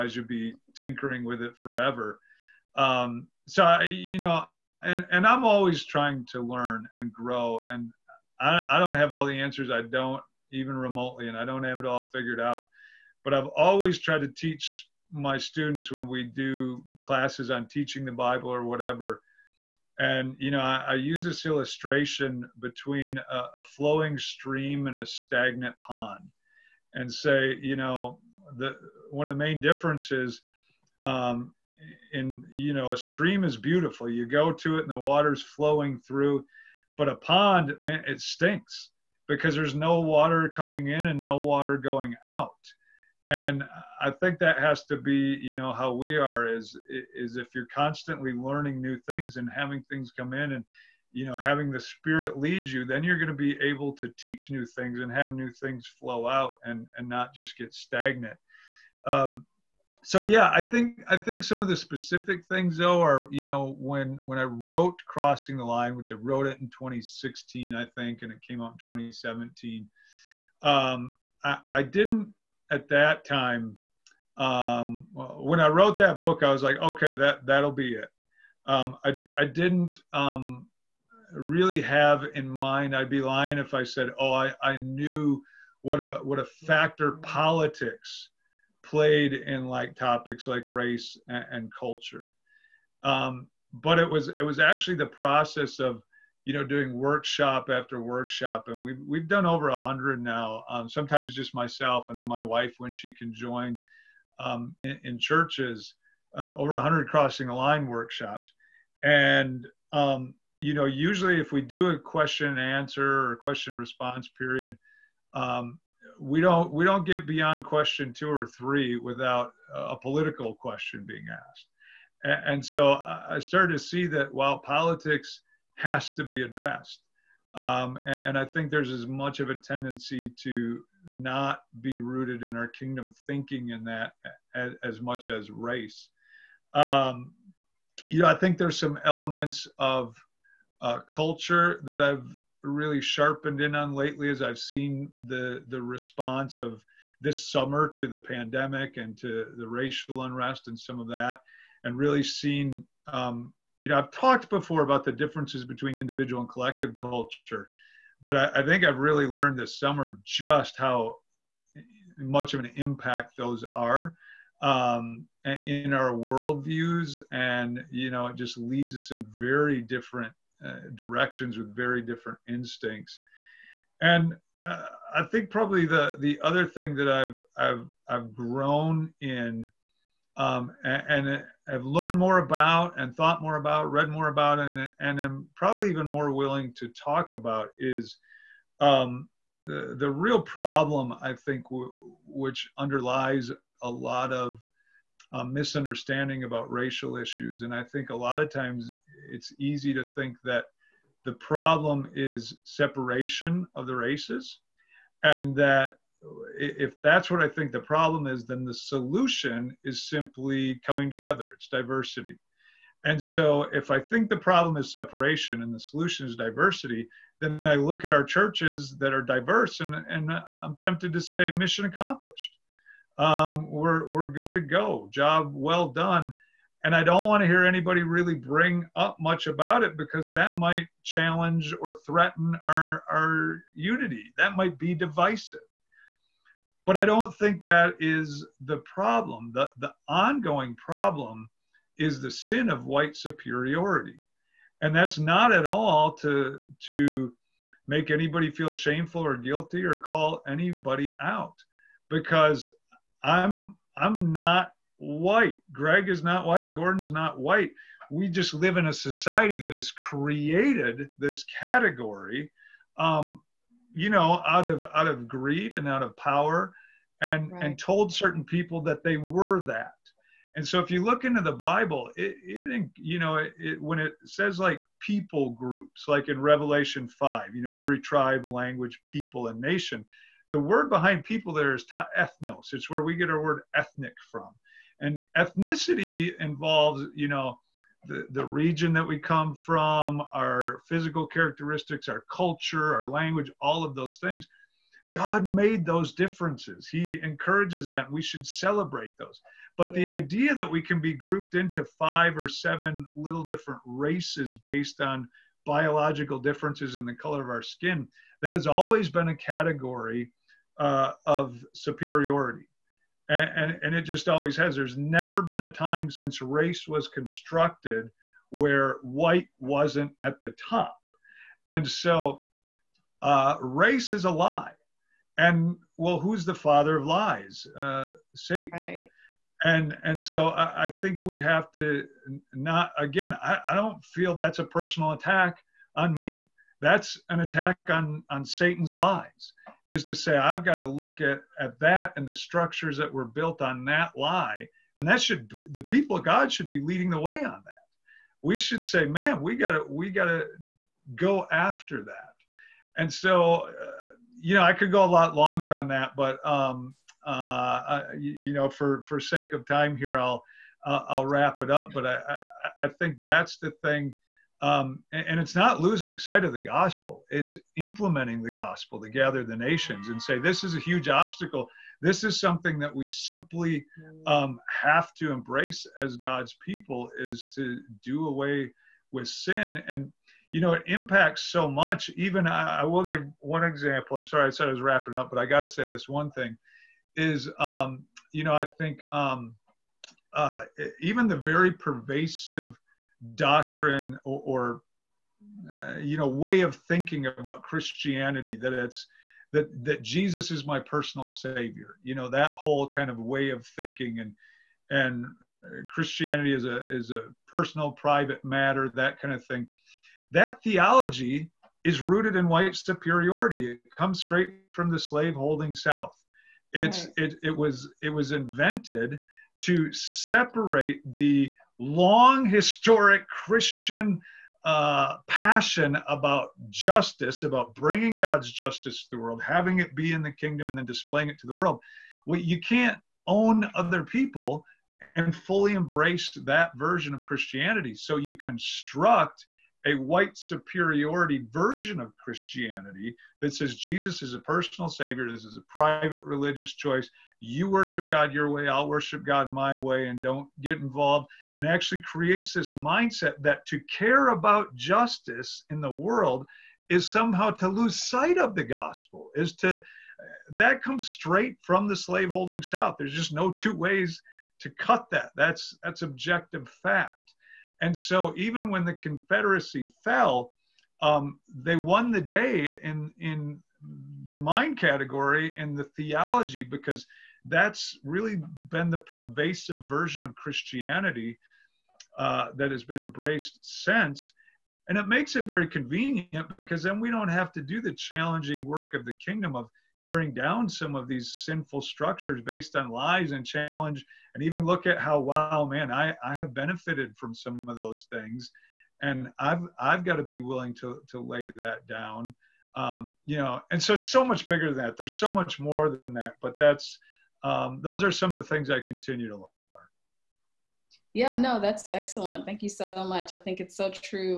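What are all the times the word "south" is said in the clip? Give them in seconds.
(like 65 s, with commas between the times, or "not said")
415 s, 462 s.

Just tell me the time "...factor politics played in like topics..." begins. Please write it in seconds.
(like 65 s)
86 s.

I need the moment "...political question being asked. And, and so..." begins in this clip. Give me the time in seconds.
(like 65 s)
119 s.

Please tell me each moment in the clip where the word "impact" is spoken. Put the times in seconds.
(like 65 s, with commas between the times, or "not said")
162 s, 380 s.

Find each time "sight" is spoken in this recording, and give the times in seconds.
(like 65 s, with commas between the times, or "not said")
366 s, 458 s.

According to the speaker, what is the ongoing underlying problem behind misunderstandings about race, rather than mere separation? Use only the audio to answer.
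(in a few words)
Sin of white superiority.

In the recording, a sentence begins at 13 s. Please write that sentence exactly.
But I've always tried to teach my students when we do classes on teaching the Bible or whatever.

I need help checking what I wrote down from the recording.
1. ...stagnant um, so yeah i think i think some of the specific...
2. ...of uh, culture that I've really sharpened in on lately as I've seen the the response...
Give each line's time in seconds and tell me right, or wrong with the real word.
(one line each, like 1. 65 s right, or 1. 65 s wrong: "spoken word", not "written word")
1. 57 s right
2. 139 s right.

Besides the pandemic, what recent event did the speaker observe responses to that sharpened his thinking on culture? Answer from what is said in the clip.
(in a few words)
Racial unrest.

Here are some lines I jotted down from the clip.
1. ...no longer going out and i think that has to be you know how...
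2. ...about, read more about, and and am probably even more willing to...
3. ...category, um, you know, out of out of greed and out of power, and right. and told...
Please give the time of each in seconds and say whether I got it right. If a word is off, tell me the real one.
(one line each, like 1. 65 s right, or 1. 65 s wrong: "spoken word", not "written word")
1. 41 s wrong: "water", not "longer"
2. 183 s right
3. 261 s right.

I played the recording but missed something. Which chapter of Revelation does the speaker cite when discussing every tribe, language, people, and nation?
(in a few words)
Revelation 5.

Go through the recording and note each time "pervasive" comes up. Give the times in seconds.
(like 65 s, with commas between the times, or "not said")
391 s, 478 s.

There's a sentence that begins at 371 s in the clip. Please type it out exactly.
This is something that we simply um, have to embrace as God's people is to do away with sin.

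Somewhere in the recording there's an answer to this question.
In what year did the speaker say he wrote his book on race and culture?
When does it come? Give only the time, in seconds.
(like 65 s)
66 s.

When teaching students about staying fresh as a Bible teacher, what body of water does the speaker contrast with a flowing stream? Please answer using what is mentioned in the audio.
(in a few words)
Stagnant pond.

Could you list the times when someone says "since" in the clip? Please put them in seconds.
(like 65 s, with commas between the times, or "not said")
316 s, 483 s.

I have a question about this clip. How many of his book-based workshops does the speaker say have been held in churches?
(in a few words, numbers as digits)
Over 100.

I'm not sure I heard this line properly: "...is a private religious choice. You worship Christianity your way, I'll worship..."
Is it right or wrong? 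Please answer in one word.
wrong.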